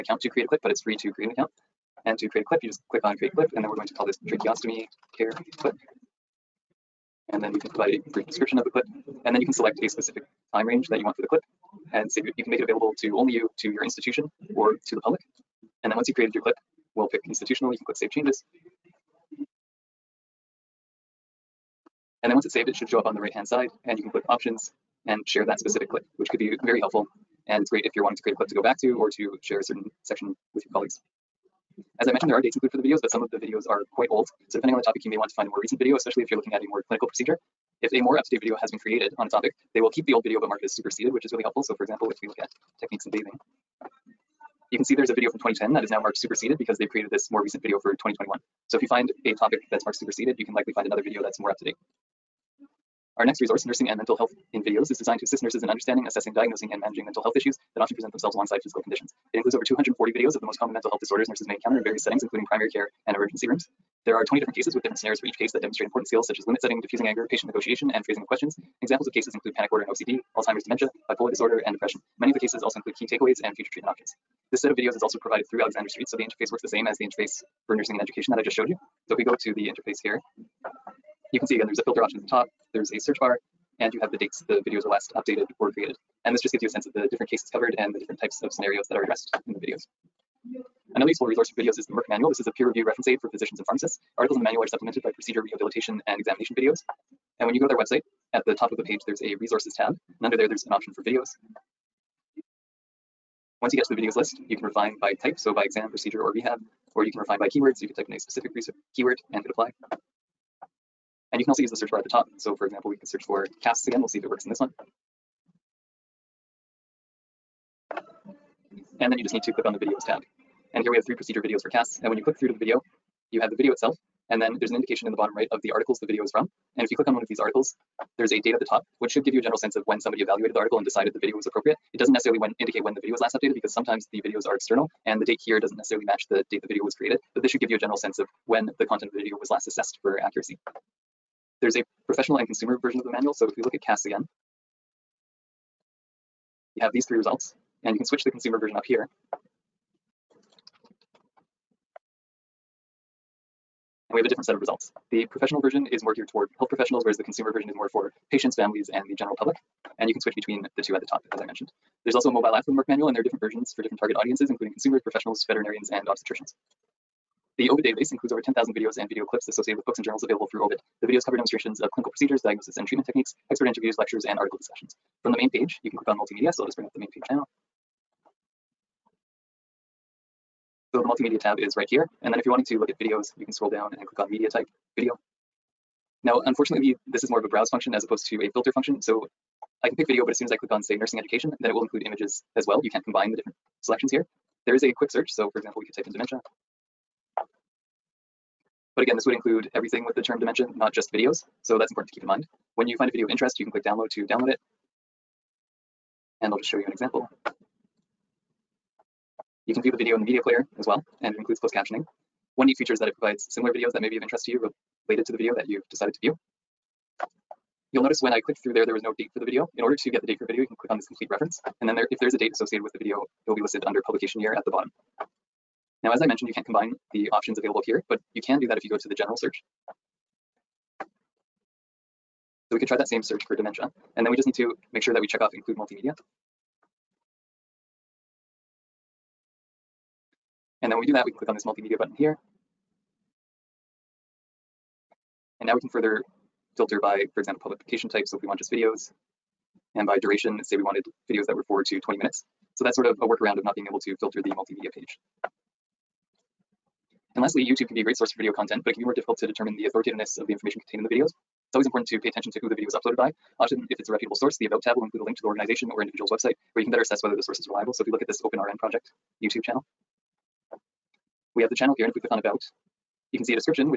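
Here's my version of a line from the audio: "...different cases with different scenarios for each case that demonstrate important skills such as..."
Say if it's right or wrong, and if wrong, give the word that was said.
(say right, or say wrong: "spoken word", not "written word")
right.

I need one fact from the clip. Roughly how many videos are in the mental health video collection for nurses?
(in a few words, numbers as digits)
over 240.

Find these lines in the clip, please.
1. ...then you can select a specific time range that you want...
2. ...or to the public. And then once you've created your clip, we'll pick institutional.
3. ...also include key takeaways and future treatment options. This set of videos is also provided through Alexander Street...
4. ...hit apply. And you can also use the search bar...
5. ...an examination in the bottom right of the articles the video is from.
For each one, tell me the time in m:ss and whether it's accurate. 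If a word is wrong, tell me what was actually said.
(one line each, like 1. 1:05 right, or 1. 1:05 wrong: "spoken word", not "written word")
1. 0:09 right
2. 0:14 right
3. 1:12 right
4. 1:49 right
5. 2:04 wrong: "indication", not "examination".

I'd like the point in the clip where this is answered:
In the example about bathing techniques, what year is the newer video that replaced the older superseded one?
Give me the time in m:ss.
0:47.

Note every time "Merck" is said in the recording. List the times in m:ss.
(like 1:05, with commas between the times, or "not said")
1:31, 2:42.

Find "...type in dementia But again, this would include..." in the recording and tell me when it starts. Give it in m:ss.
3:15.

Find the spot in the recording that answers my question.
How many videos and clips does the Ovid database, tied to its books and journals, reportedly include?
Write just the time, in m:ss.
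2:48.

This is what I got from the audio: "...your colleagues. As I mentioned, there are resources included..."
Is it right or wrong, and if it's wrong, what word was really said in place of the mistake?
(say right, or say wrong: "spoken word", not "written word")
wrong: "dates", not "resources".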